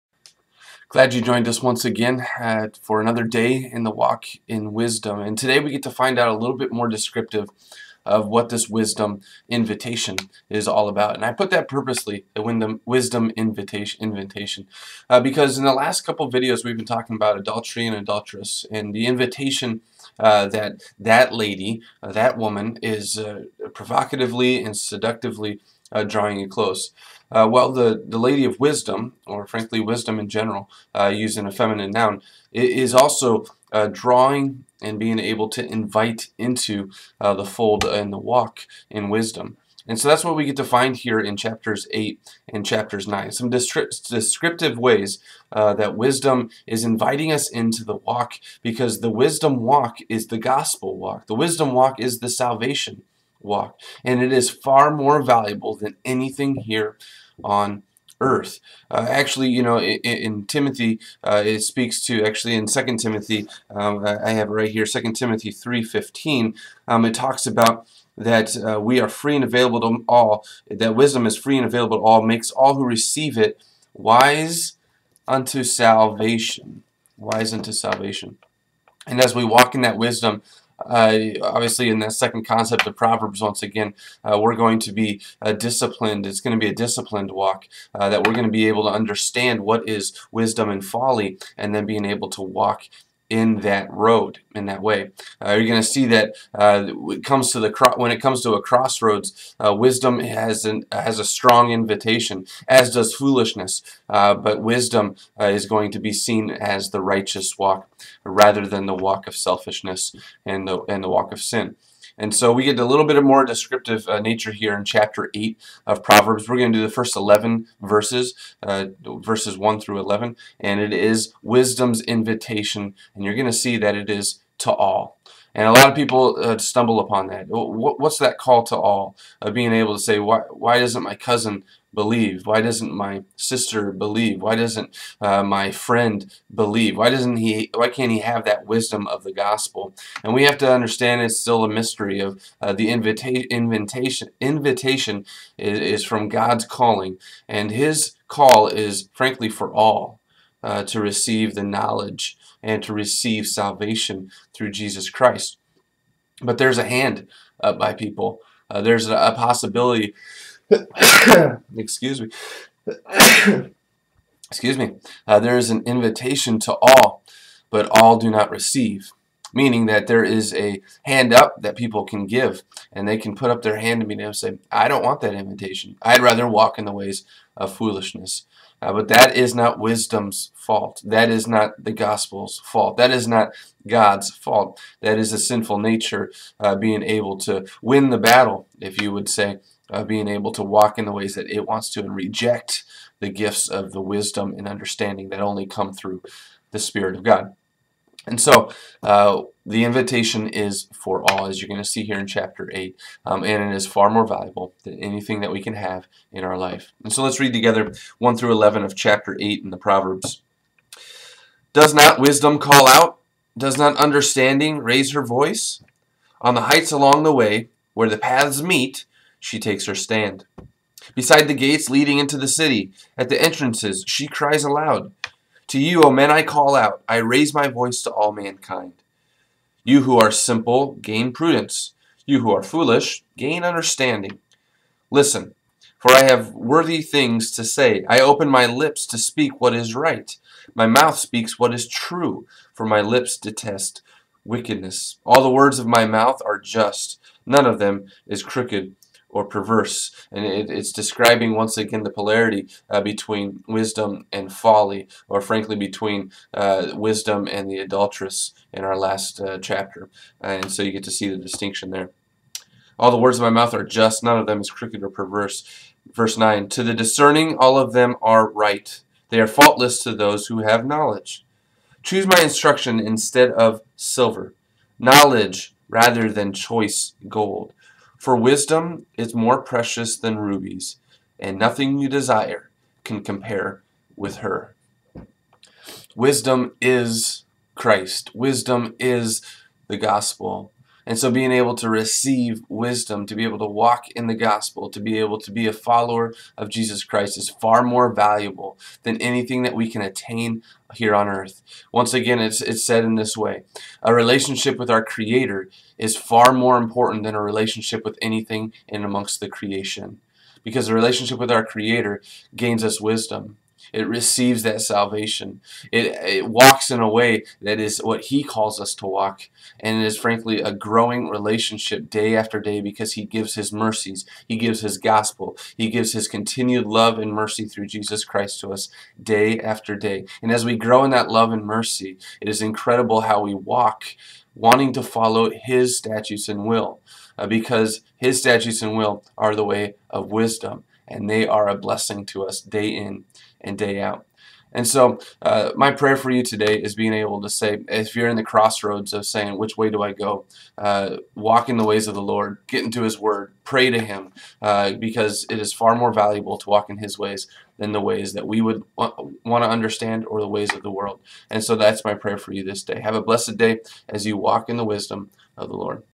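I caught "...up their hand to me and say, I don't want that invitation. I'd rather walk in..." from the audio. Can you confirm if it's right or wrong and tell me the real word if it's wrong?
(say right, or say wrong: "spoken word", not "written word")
right.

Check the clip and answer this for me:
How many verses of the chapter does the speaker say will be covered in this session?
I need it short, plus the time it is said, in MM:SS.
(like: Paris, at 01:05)
11, at 01:56.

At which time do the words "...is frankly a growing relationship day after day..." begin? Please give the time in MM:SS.
05:20.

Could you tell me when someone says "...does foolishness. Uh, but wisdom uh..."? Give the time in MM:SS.
01:42.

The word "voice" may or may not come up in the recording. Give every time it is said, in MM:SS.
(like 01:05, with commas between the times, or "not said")
03:35, 03:47.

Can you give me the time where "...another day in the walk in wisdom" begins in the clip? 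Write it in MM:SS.
00:02.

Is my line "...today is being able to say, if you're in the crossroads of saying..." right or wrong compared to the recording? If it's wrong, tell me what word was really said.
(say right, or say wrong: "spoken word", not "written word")
right.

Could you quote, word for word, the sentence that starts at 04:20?
and so you get to see the distinction there.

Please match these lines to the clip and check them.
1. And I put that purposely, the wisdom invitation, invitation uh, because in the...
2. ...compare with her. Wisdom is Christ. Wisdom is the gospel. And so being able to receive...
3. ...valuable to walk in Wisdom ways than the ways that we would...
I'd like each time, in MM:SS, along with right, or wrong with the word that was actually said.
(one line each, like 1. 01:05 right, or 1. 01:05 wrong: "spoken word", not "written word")
1. 00:11 right
2. 04:43 right
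3. 05:56 wrong: "His", not "Wisdom".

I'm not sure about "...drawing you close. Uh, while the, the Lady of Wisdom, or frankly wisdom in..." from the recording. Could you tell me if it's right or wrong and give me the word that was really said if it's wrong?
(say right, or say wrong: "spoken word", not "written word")
right.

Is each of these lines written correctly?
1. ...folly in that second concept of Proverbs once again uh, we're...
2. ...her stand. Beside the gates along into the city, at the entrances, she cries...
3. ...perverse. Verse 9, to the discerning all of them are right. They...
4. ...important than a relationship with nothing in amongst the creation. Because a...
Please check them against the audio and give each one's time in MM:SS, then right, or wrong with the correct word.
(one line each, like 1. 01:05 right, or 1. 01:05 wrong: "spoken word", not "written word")
1. 01:21 wrong: "obviously", not "folly"
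2. 03:39 wrong: "leading", not "along"
3. 04:25 right
4. 05:06 wrong: "anything", not "nothing".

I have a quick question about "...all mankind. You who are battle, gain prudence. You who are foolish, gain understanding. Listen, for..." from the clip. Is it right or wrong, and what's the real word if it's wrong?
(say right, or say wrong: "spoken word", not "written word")
wrong: "simple", not "battle".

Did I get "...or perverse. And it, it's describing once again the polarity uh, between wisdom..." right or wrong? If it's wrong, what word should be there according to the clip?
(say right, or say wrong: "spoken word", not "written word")
right.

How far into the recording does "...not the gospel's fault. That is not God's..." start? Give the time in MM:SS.
03:01.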